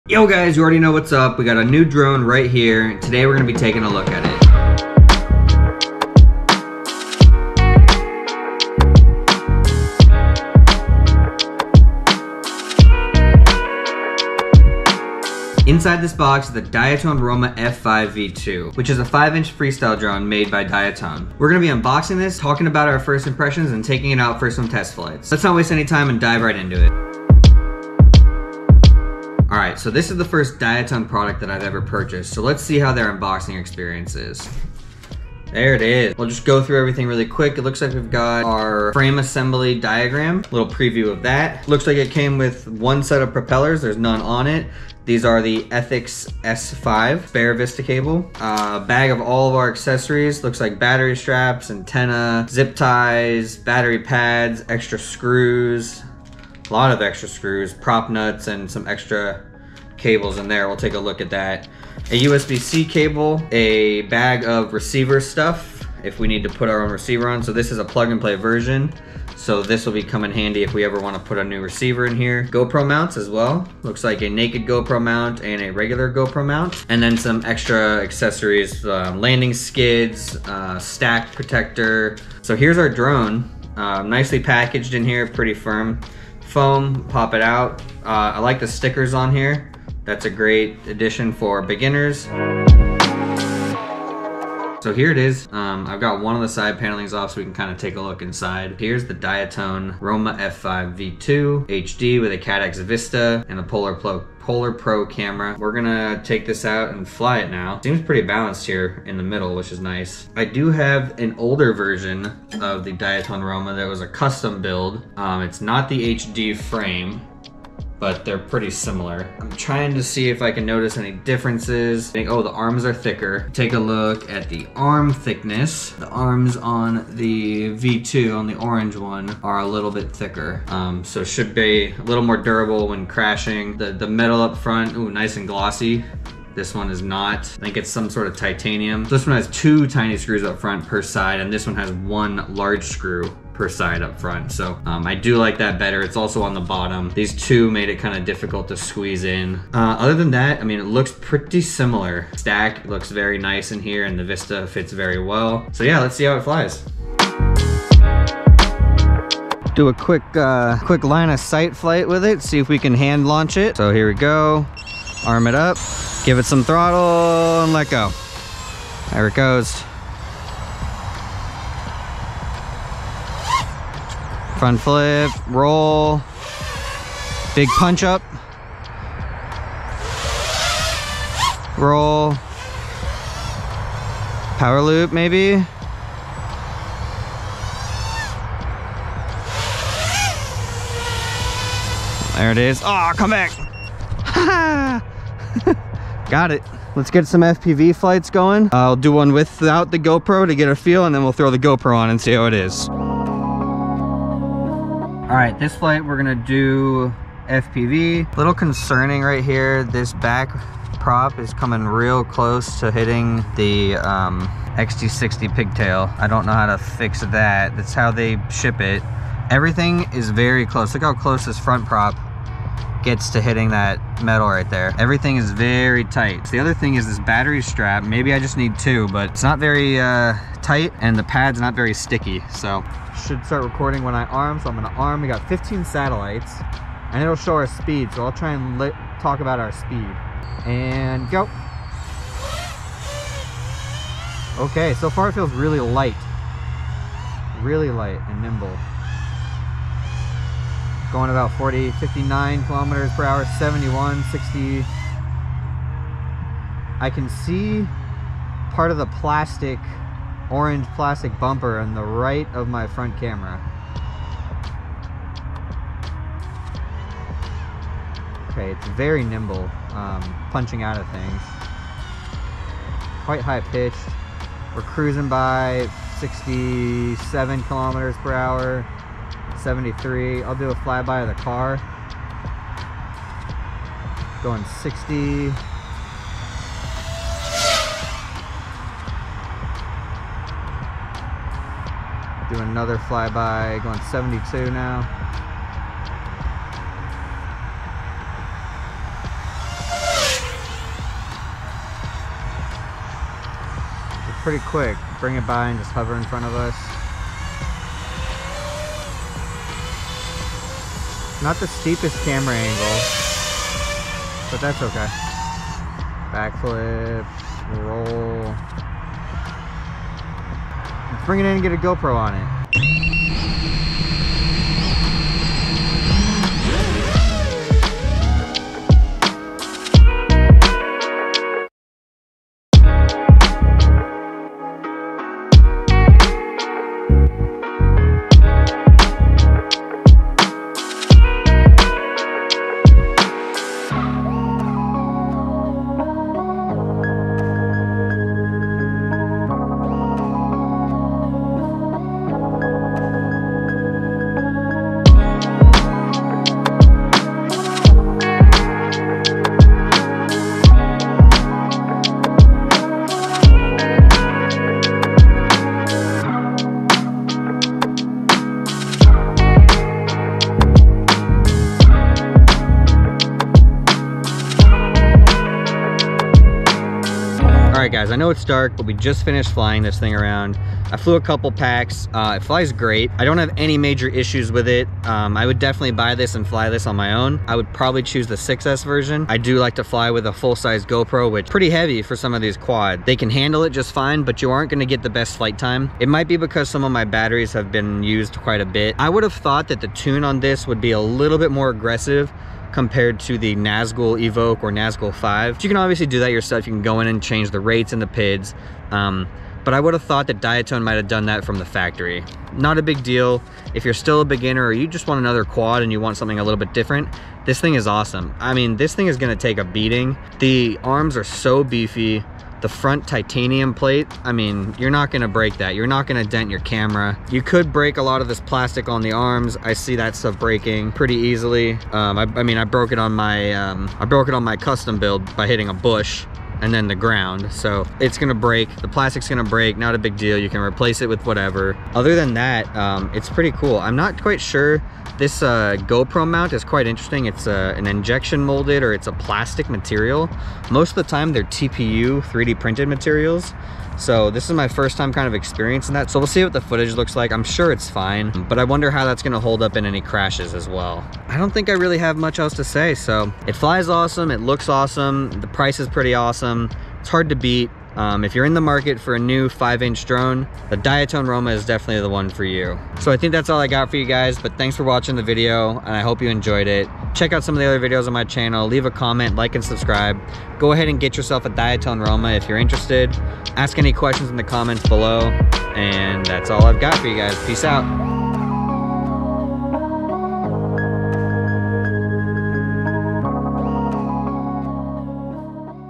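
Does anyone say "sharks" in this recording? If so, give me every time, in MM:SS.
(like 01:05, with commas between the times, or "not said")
not said.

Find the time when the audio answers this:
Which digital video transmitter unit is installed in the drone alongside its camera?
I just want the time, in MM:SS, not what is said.
01:42.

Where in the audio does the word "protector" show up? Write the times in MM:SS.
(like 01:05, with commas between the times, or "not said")
01:21.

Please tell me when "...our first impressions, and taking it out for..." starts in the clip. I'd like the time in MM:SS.
00:22.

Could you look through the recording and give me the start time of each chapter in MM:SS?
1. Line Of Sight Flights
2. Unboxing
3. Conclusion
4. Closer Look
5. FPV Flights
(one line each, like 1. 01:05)
1. 02:37
2. 00:27
3. 06:15
4. 01:33
5. 03:23.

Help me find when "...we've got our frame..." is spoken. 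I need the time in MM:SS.
00:37.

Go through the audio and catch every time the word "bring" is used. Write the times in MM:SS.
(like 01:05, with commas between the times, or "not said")
05:05, 05:21.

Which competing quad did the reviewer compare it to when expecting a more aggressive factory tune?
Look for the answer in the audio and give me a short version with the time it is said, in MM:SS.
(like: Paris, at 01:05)
Nazgul Evoque, at 06:43.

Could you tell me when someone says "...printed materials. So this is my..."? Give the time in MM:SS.
07:32.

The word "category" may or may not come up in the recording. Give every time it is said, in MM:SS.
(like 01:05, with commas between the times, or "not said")
not said.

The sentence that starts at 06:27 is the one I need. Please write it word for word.
I would probably choose the 6S version.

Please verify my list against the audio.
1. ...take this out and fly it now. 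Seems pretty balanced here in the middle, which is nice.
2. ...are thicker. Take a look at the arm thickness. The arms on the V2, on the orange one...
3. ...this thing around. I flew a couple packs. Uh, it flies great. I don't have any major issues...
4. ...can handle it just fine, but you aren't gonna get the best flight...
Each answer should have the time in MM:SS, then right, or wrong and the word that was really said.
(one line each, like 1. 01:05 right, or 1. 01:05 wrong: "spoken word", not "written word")
1. 01:46 right
2. 02:02 right
3. 06:19 right
4. 06:33 right.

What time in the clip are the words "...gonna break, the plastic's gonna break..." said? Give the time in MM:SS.
07:18.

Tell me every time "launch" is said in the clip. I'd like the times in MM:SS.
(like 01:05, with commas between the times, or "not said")
02:43.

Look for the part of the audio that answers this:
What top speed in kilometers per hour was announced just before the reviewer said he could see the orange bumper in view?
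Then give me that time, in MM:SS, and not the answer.
04:13.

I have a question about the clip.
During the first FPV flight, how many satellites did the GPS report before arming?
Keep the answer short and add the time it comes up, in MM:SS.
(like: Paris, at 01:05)
15, at 03:55.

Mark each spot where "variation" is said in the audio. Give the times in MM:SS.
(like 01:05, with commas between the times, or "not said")
not said.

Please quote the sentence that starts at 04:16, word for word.
I can see part of the plastic, orange plastic bumper on the right of my front camera.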